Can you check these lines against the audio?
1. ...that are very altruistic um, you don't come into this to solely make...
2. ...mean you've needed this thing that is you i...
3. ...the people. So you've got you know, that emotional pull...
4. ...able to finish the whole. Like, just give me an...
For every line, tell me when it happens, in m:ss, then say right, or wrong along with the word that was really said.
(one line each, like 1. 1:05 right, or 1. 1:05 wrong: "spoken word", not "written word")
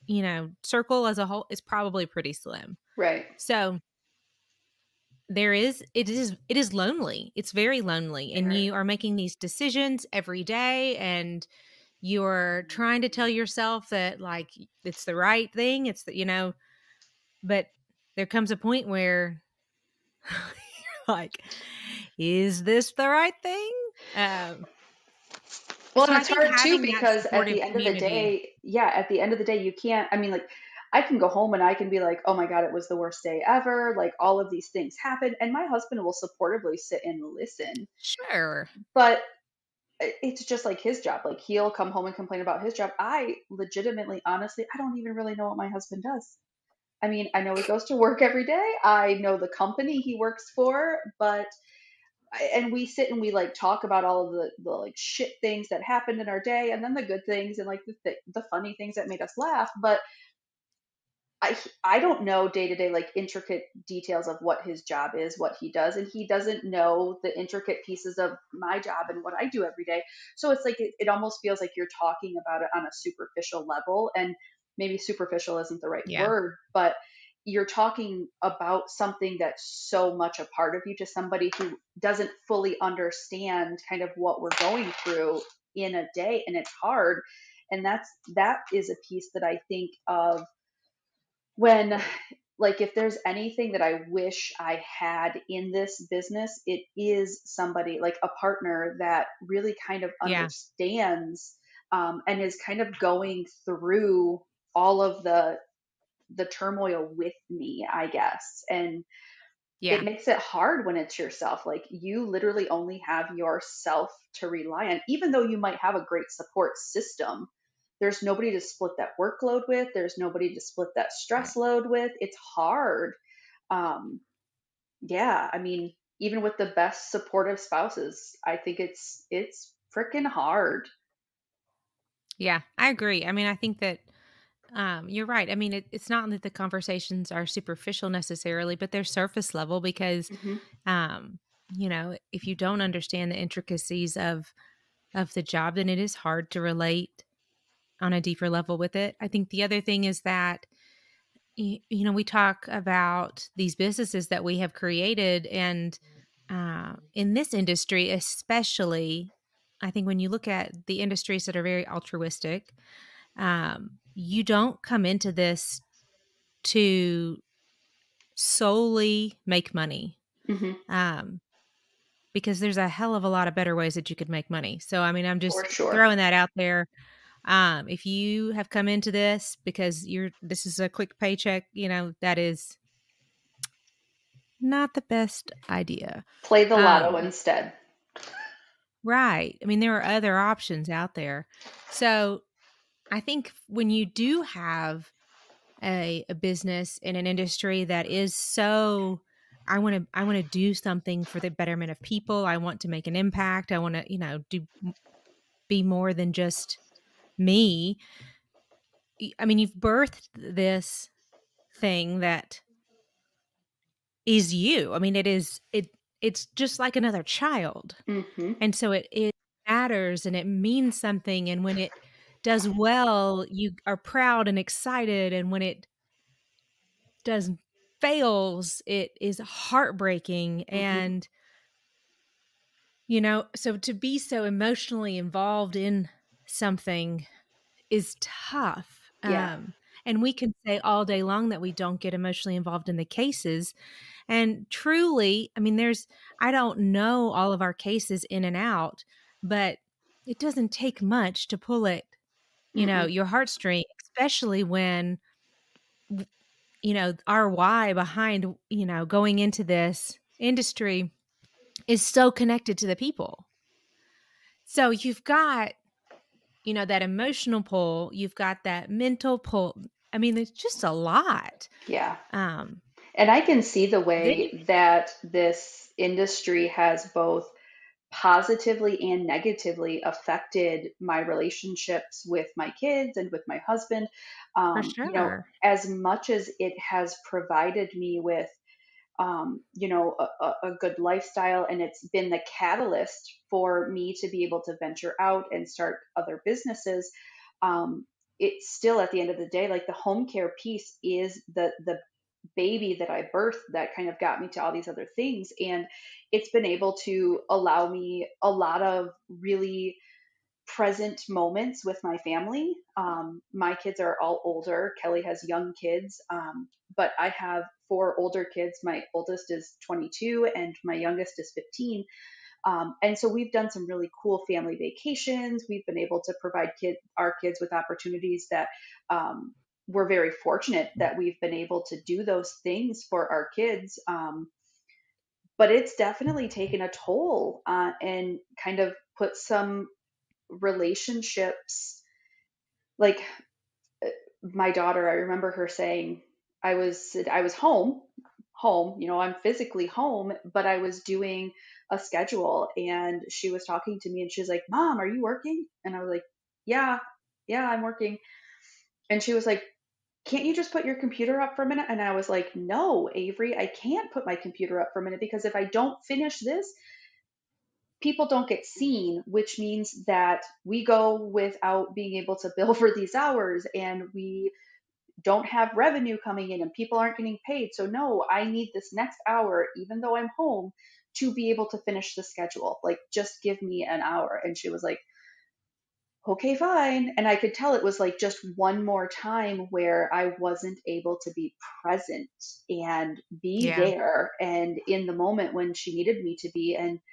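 1. 2:41 right
2. 3:29 wrong: "birthed", not "needed"
3. 4:22 right
4. 6:21 wrong: "schedule", not "whole".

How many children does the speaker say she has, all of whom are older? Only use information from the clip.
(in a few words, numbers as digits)
4.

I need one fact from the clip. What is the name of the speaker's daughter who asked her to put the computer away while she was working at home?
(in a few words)
Avery.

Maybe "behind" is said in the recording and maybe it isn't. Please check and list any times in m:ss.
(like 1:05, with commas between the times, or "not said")
4:17.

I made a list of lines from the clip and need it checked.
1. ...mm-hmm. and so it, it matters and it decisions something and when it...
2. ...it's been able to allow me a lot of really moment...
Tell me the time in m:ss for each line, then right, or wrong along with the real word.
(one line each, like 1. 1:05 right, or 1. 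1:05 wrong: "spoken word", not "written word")
1. 3:38 wrong: "means", not "decisions"
2. 5:06 wrong: "present", not "moment".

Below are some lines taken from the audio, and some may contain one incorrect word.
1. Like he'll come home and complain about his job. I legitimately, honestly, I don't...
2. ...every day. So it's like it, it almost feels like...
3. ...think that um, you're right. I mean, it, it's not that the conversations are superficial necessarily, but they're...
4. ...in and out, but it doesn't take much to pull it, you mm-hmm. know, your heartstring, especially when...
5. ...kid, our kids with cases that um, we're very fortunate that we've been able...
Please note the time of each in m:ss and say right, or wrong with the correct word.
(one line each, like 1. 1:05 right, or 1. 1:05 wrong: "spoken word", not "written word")
1. 0:41 right
2. 1:09 right
3. 2:13 right
4. 4:08 right
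5. 5:26 wrong: "opportunities", not "cases".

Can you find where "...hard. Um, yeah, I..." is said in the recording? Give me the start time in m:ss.
2:02.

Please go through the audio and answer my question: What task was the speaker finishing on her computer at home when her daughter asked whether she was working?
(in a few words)
A schedule.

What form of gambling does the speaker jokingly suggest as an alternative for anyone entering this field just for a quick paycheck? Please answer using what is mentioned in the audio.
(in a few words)
The lotto.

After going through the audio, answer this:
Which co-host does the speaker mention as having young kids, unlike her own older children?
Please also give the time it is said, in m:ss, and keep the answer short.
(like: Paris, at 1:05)
Kelly, at 5:15.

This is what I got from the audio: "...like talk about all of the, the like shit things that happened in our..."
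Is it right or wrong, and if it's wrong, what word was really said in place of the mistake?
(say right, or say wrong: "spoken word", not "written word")
right.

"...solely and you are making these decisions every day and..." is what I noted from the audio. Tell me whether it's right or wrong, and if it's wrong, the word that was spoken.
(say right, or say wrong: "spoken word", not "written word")
wrong: "lonely", not "solely".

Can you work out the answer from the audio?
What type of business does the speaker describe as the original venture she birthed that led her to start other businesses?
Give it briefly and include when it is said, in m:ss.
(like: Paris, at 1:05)
Home care, at 4:59.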